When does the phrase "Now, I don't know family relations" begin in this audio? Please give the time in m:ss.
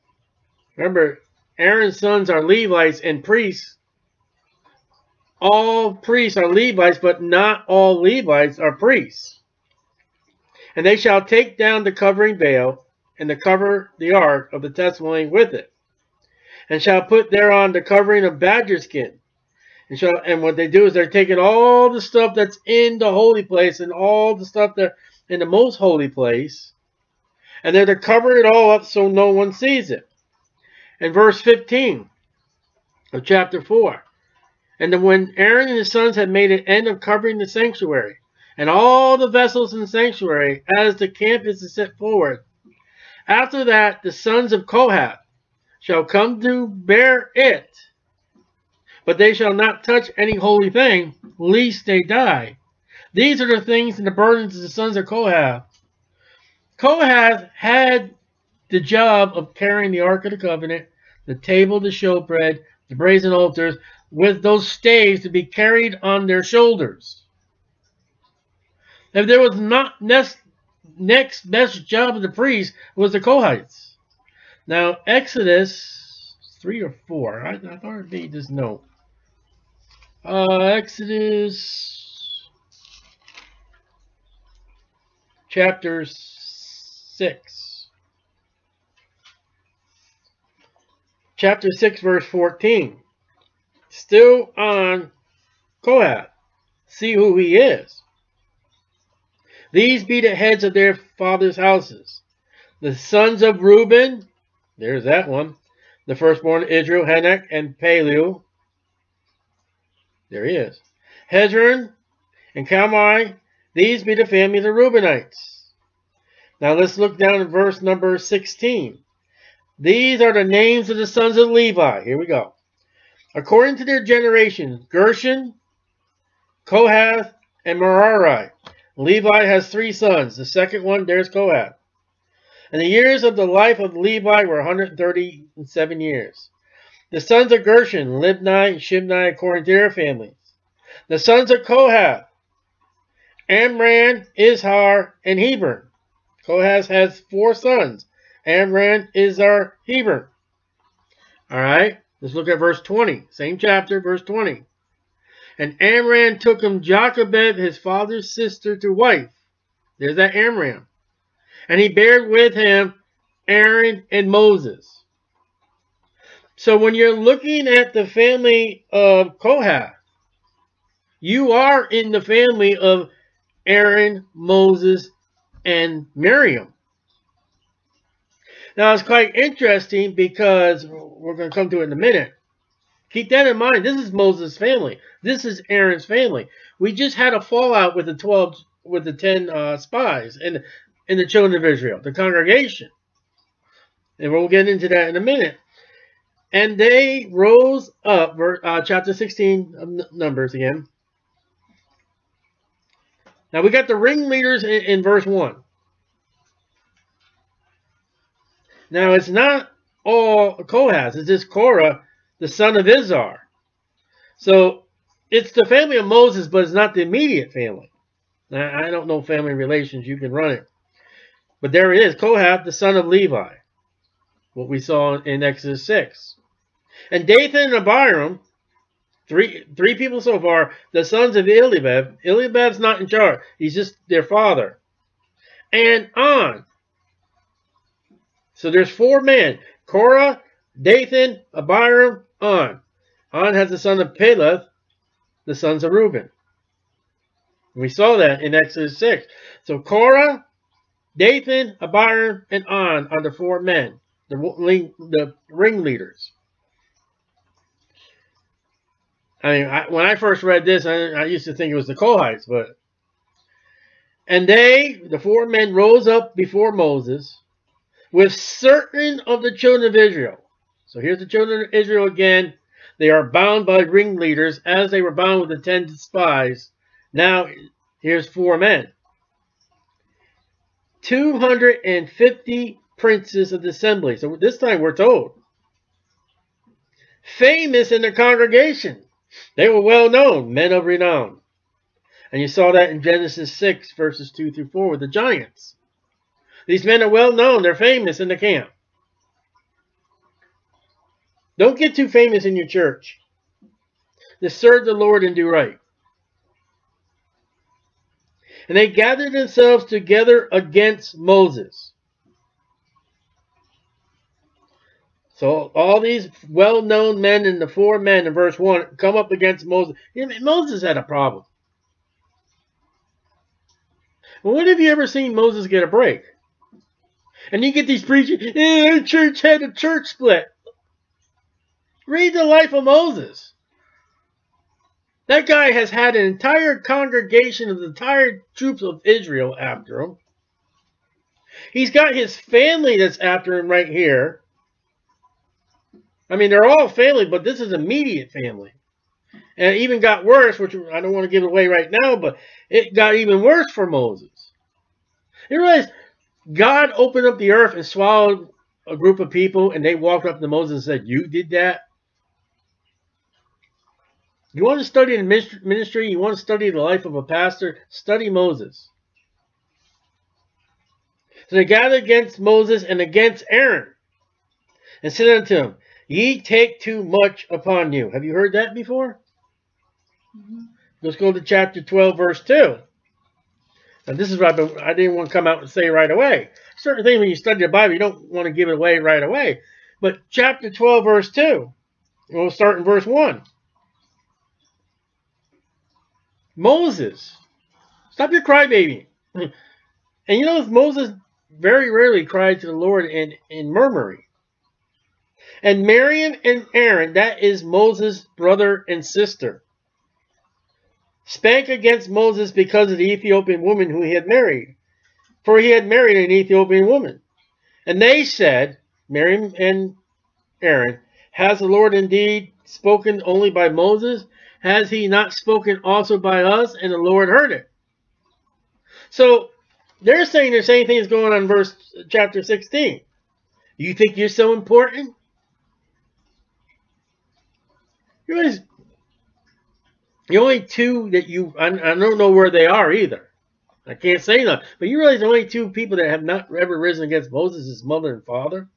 3:38.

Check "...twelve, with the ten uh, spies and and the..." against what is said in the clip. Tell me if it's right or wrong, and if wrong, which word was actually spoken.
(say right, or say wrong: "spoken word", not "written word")
right.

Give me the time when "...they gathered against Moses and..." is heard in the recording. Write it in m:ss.
6:11.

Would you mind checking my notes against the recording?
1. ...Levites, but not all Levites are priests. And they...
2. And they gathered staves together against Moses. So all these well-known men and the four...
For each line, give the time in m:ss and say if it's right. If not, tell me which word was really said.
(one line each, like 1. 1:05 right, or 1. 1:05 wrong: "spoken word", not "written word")
1. 0:06 right
2. 5:08 wrong: "themselves", not "staves".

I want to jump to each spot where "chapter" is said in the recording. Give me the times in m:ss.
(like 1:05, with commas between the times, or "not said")
0:33, 1:25, 1:31, 2:33, 3:18, 6:21, 6:30, 7:12.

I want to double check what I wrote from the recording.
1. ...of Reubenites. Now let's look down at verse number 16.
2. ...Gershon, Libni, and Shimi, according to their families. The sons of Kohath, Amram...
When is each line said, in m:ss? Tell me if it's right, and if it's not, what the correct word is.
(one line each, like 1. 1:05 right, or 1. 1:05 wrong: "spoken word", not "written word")
1. 1:54 right
2. 2:17 right.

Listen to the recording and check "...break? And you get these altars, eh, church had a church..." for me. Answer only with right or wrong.
wrong.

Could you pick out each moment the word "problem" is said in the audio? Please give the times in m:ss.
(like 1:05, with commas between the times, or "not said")
5:21.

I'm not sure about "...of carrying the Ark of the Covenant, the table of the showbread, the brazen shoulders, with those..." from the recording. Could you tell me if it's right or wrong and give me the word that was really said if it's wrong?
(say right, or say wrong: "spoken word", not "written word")
wrong: "altars", not "shoulders".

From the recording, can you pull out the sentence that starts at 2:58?
Now it's quite interesting because we're going to come to it in a minute.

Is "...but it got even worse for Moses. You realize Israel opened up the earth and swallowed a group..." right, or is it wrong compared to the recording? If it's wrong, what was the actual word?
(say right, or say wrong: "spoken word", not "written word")
wrong: "God", not "Israel".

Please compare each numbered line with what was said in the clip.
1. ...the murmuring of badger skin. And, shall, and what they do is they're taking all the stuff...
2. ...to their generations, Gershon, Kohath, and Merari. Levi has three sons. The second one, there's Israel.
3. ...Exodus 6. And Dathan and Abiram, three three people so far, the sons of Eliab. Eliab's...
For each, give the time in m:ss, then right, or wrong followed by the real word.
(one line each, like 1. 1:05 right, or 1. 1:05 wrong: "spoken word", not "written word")
1. 0:17 wrong: "covering", not "murmuring"
2. 2:03 wrong: "Kohath", not "Israel"
3. 3:45 right.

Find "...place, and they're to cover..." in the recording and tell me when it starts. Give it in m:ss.
0:26.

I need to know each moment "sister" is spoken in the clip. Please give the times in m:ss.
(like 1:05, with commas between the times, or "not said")
2:38, 6:49.